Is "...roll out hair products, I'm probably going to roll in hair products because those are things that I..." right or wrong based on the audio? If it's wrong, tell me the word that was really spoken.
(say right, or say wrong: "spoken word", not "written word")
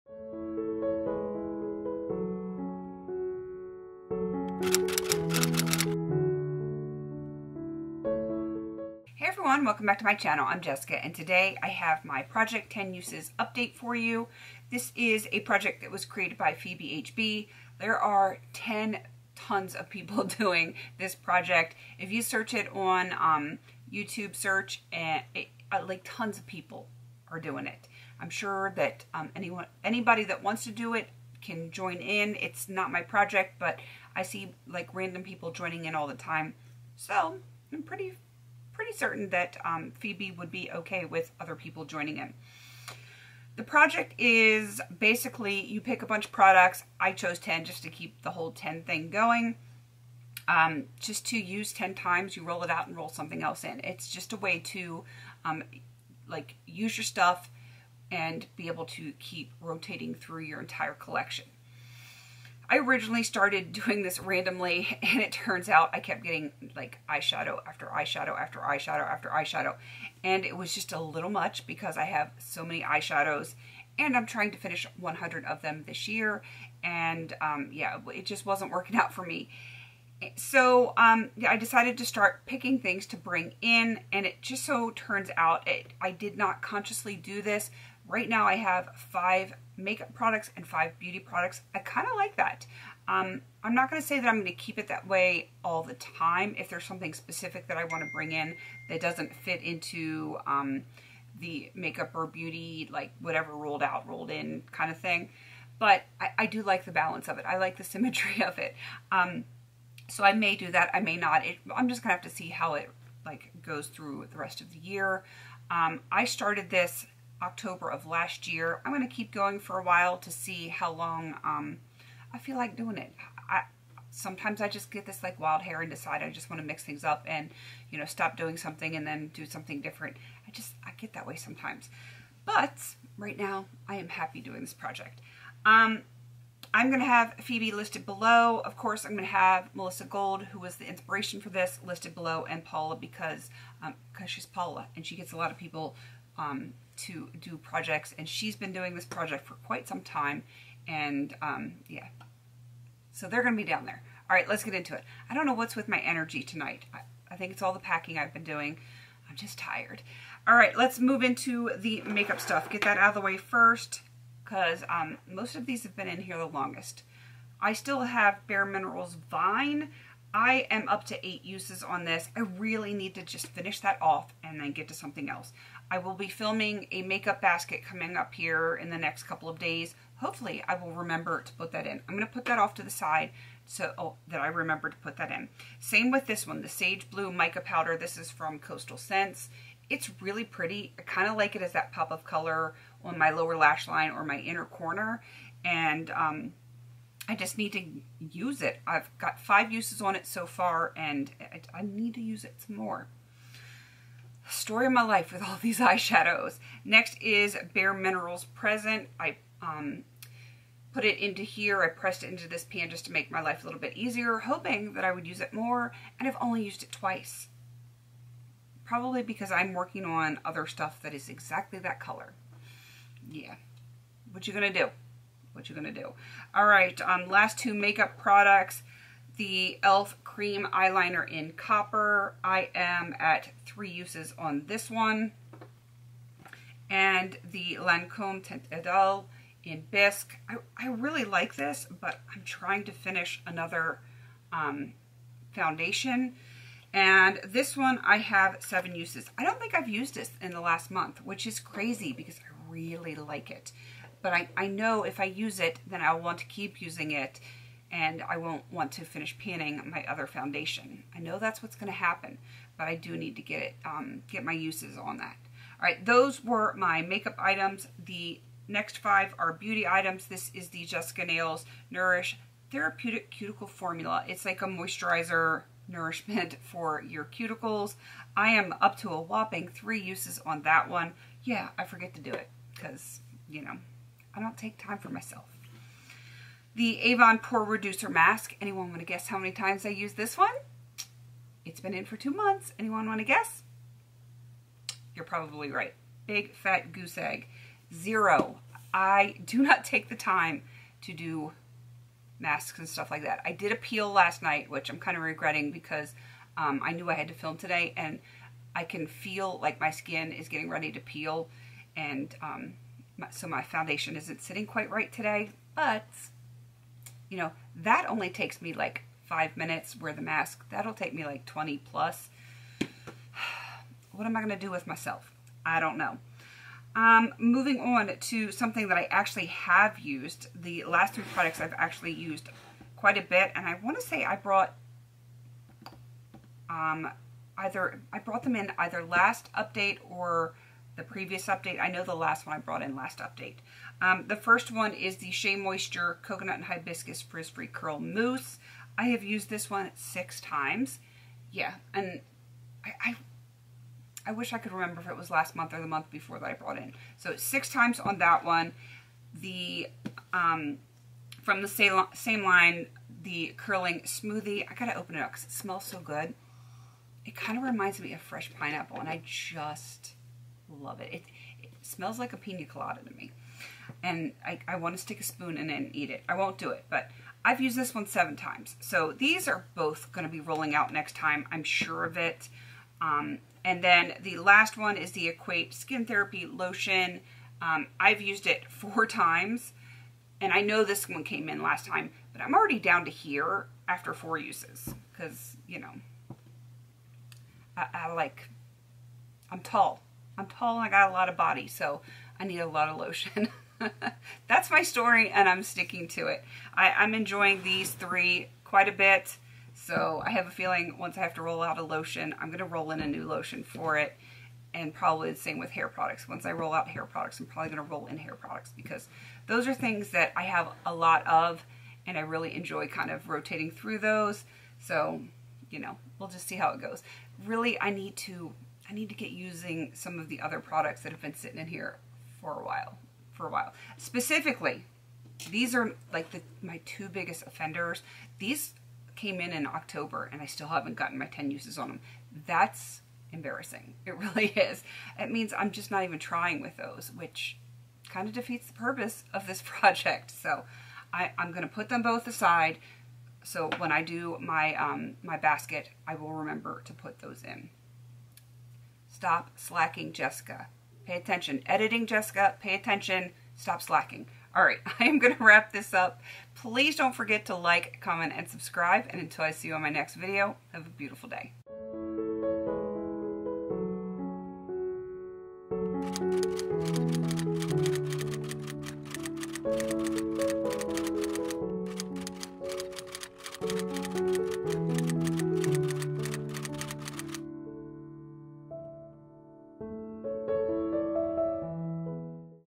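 right.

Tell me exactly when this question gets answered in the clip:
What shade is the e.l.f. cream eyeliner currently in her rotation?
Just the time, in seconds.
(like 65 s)
231 s.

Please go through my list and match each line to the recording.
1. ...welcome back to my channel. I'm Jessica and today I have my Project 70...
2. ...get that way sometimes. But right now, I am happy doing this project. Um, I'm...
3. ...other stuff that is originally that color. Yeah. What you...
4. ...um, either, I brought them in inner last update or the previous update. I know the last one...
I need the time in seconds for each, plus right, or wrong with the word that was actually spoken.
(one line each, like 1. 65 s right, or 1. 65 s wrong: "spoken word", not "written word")
1. 9 s wrong: "10", not "70"
2. 130 s right
3. 220 s wrong: "exactly", not "originally"
4. 336 s wrong: "either", not "inner".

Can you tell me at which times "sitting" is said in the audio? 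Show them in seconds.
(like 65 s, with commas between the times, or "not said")
314 s, 431 s.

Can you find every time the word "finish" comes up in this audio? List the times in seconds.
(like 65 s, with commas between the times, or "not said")
74 s, 173 s, 242 s, 259 s.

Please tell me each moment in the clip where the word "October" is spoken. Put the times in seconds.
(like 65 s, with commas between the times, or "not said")
117 s, 439 s.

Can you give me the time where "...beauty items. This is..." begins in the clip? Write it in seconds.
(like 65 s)
269 s.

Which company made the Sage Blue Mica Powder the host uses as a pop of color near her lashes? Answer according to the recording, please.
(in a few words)
Coastal Scents.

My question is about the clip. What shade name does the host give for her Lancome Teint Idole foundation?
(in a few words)
Bisque.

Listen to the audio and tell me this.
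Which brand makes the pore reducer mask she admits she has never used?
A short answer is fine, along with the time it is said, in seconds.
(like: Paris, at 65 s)
Avon, at 287 s.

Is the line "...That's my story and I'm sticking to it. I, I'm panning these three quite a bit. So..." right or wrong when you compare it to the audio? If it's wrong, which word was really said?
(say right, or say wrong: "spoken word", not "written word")
wrong: "enjoying", not "panning".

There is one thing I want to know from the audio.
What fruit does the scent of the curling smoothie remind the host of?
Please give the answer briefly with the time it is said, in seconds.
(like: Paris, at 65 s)
Fresh pineapple, at 368 s.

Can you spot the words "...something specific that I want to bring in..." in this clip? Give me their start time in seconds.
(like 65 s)
96 s.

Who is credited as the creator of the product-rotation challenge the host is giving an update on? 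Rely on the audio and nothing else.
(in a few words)
Phoebe HB.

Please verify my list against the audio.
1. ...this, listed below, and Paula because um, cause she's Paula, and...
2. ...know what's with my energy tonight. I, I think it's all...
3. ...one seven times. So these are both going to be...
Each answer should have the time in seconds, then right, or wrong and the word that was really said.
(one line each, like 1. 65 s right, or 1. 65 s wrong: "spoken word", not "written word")
1. 141 s right
2. 155 s right
3. 377 s right.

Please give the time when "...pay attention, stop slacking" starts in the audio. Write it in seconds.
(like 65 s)
462 s.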